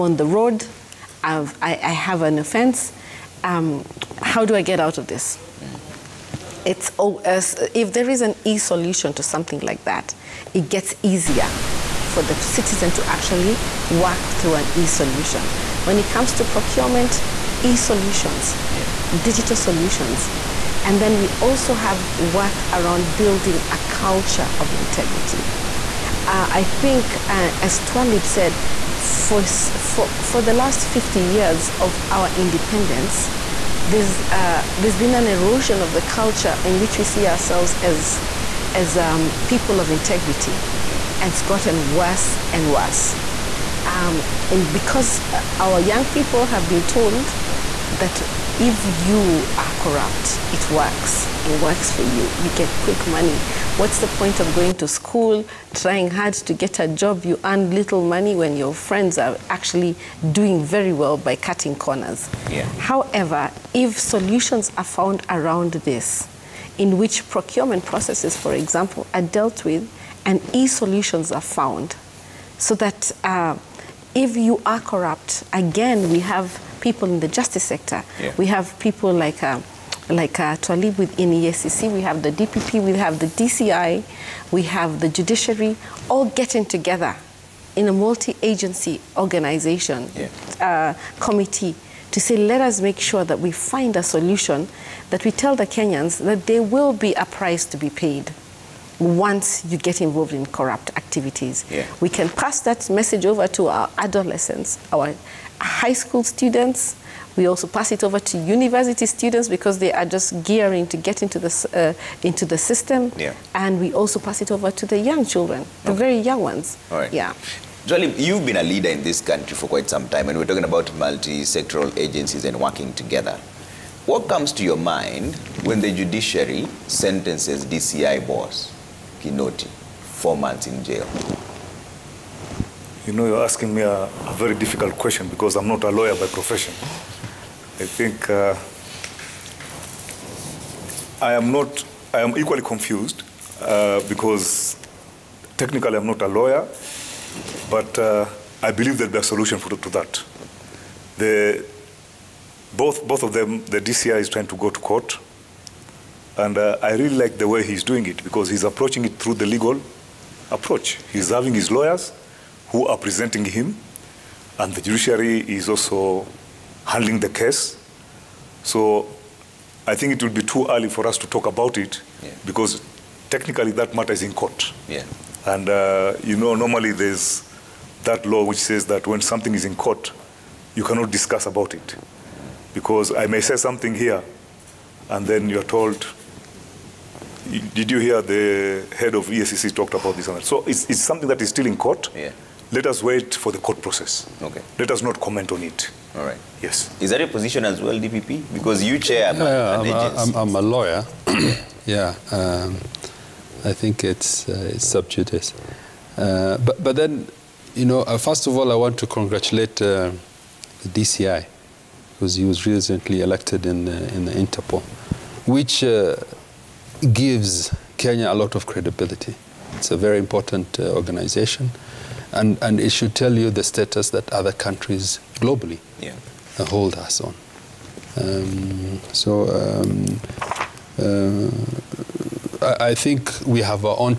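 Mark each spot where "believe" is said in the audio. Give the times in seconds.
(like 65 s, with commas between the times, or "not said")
148 s.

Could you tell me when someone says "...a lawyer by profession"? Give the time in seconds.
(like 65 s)
135 s.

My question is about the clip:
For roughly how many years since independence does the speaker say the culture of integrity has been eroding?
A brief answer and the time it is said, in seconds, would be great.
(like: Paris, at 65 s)
50, at 30 s.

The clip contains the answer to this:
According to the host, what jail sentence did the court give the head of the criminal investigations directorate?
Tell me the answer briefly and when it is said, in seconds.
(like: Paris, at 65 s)
4 months, at 130 s.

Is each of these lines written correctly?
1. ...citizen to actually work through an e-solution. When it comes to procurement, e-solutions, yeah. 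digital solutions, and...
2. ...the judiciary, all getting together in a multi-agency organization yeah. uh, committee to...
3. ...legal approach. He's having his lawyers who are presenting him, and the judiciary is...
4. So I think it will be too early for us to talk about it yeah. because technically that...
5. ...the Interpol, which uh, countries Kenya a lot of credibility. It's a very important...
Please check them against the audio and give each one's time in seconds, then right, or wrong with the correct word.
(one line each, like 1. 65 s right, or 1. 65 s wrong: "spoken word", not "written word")
1. 12 s right
2. 84 s right
3. 159 s right
4. 168 s right
5. 214 s wrong: "gives", not "countries".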